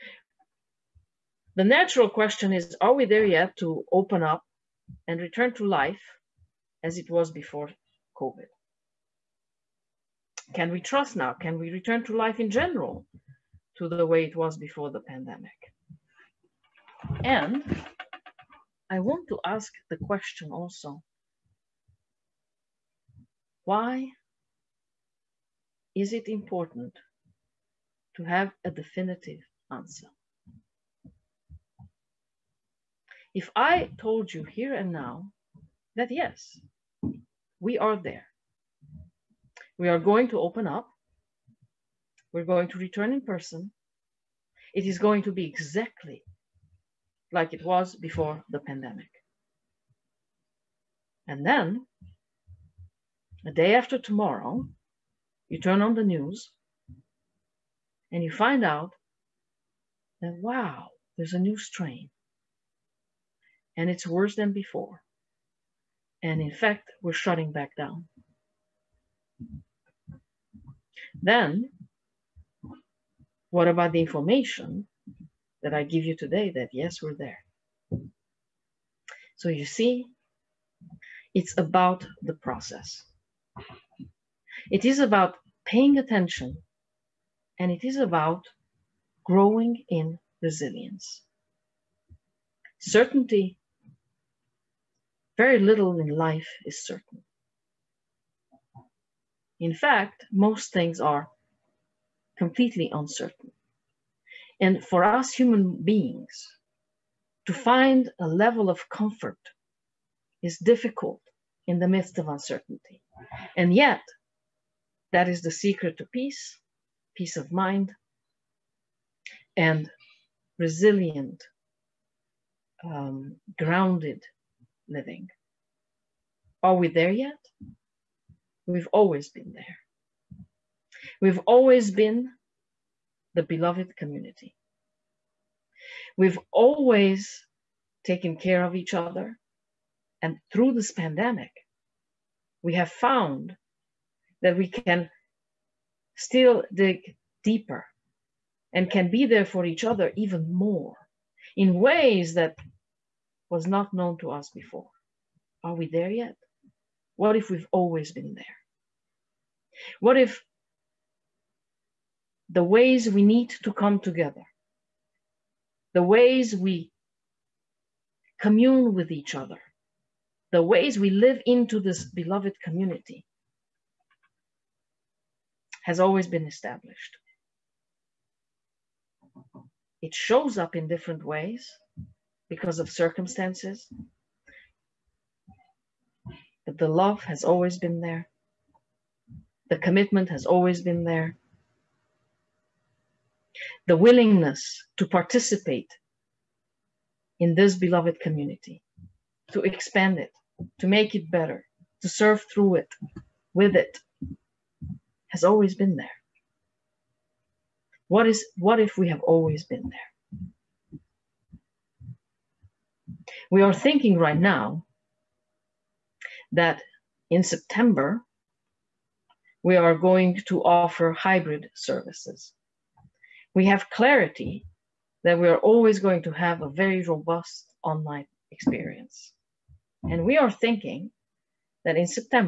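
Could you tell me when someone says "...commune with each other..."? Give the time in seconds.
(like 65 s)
168 s.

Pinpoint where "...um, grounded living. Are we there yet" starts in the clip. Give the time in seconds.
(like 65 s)
122 s.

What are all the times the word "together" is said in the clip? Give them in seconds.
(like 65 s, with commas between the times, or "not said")
164 s.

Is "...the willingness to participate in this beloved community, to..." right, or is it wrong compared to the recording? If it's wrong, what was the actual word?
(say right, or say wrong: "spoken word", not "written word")
right.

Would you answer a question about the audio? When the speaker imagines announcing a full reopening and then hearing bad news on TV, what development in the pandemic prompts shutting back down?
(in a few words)
A new strain.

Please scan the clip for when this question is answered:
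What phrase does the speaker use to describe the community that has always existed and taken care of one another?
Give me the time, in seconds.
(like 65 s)
133 s.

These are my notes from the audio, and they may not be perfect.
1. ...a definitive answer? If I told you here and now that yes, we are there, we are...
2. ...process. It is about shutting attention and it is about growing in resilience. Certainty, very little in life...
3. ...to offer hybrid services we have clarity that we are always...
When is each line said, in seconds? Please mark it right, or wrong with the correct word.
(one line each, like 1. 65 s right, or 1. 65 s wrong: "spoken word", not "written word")
1. 28 s right
2. 82 s wrong: "paying", not "shutting"
3. 220 s right.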